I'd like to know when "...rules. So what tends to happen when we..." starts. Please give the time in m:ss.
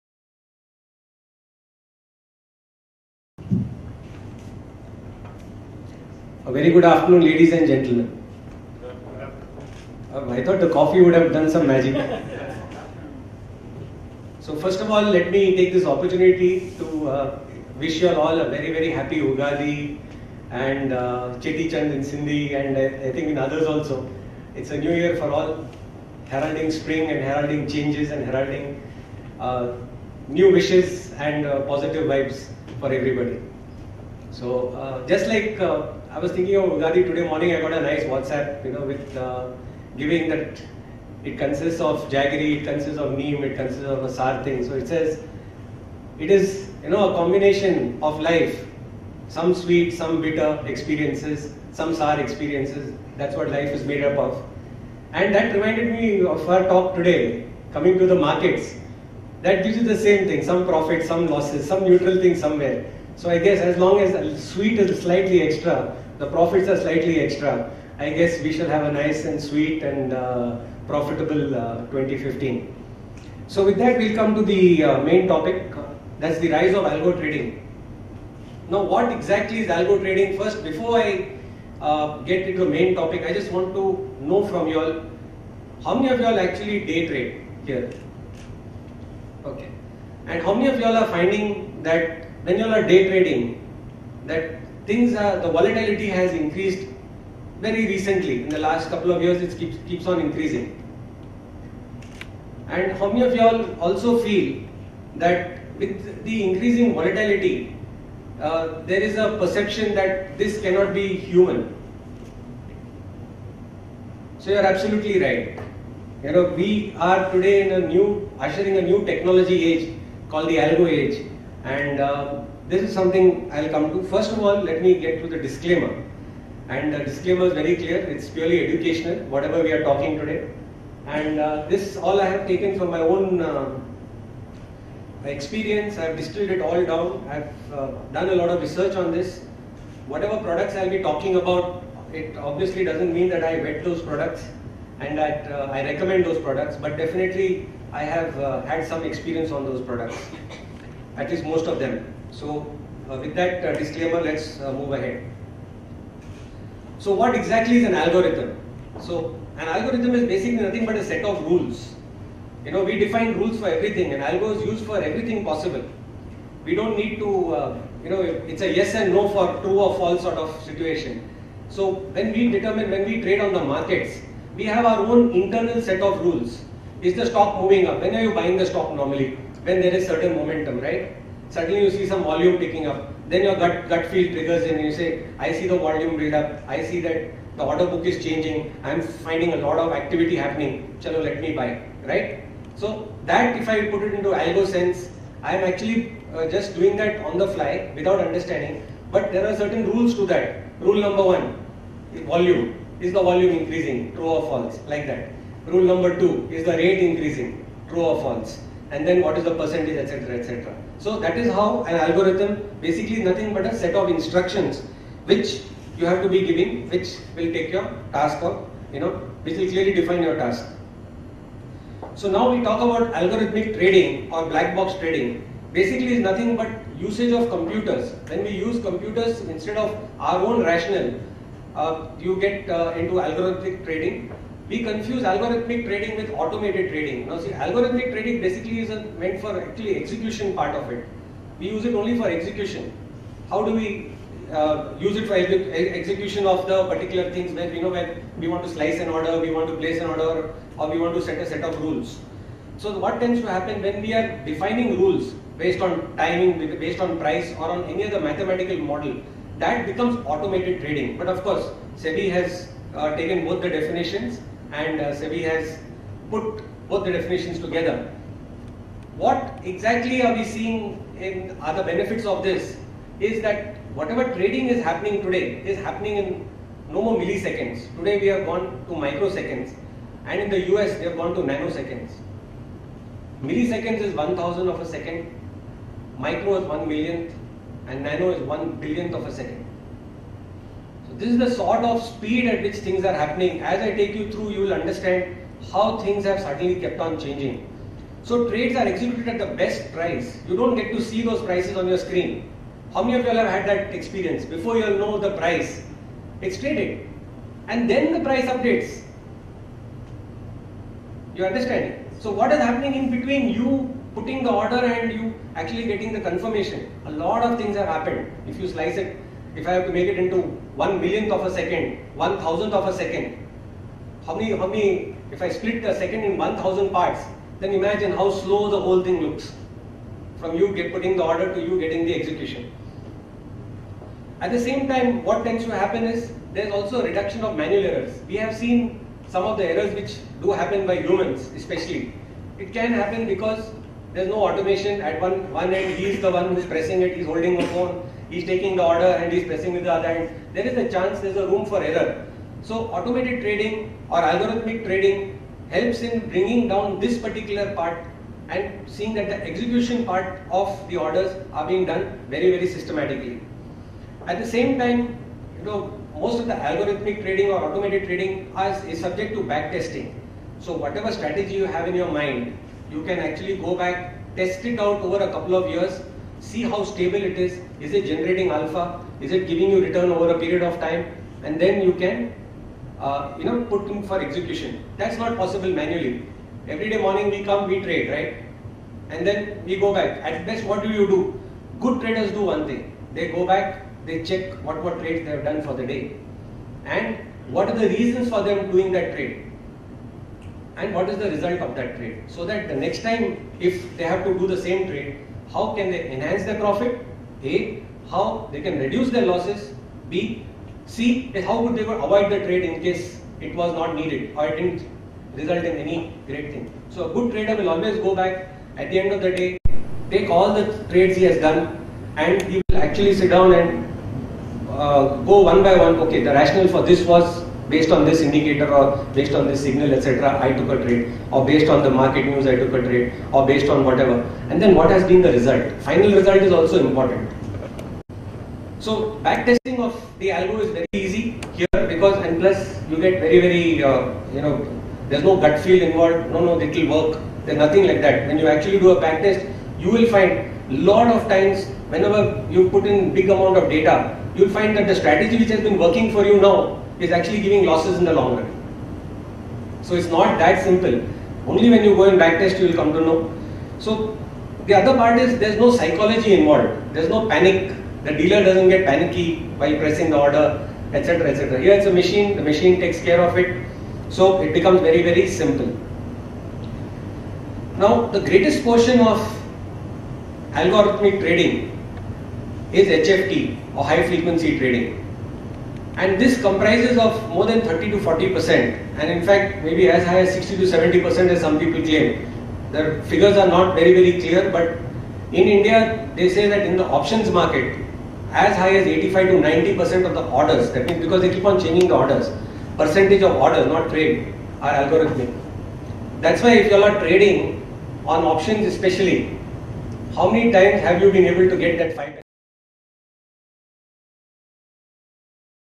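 4:11.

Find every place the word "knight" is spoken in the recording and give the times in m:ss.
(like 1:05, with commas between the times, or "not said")
not said.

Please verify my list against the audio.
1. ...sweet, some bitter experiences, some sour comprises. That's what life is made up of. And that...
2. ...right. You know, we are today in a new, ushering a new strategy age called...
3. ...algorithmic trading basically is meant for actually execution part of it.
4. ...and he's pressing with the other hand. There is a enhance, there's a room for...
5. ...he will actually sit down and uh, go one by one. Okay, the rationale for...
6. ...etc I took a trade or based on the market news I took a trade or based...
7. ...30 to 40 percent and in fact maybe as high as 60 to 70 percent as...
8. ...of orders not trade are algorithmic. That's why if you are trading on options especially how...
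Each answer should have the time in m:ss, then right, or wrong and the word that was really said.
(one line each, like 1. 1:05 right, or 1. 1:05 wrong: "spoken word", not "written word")
1. 0:49 wrong: "experiences", not "comprises"
2. 1:55 wrong: "technology", not "strategy"
3. 3:57 right
4. 5:49 wrong: "chance", not "enhance"
5. 7:02 right
6. 7:09 right
7. 8:07 right
8. 8:23 right.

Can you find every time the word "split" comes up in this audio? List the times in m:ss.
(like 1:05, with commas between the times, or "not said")
5:25.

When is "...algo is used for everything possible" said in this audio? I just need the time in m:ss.
2:44.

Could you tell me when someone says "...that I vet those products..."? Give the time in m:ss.
2:23.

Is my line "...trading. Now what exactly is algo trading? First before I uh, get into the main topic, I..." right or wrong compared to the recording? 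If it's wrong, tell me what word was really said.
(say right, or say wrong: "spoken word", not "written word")
right.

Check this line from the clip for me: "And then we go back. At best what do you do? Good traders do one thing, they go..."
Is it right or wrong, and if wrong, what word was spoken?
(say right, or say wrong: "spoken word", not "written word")
right.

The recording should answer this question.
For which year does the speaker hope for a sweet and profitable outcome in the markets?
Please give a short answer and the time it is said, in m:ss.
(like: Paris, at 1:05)
2015, at 1:11.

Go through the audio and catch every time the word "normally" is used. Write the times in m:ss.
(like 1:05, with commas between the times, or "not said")
2:58.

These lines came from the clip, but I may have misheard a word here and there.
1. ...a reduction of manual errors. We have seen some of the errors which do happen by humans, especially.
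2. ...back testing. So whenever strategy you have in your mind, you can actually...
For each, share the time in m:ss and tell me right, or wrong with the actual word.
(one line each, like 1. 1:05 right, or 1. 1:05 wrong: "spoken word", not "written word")
1. 5:37 right
2. 6:09 wrong: "whatever", not "whenever".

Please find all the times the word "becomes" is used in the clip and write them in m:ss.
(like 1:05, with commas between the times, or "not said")
4:19, 7:54.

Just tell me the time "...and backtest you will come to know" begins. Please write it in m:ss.
7:42.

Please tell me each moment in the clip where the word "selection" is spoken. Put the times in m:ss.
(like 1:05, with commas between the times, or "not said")
not said.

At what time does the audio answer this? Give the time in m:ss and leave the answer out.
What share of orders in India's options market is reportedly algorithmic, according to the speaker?
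8:18.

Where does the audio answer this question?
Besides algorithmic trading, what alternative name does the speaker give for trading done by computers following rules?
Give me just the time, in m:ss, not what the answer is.
3:44.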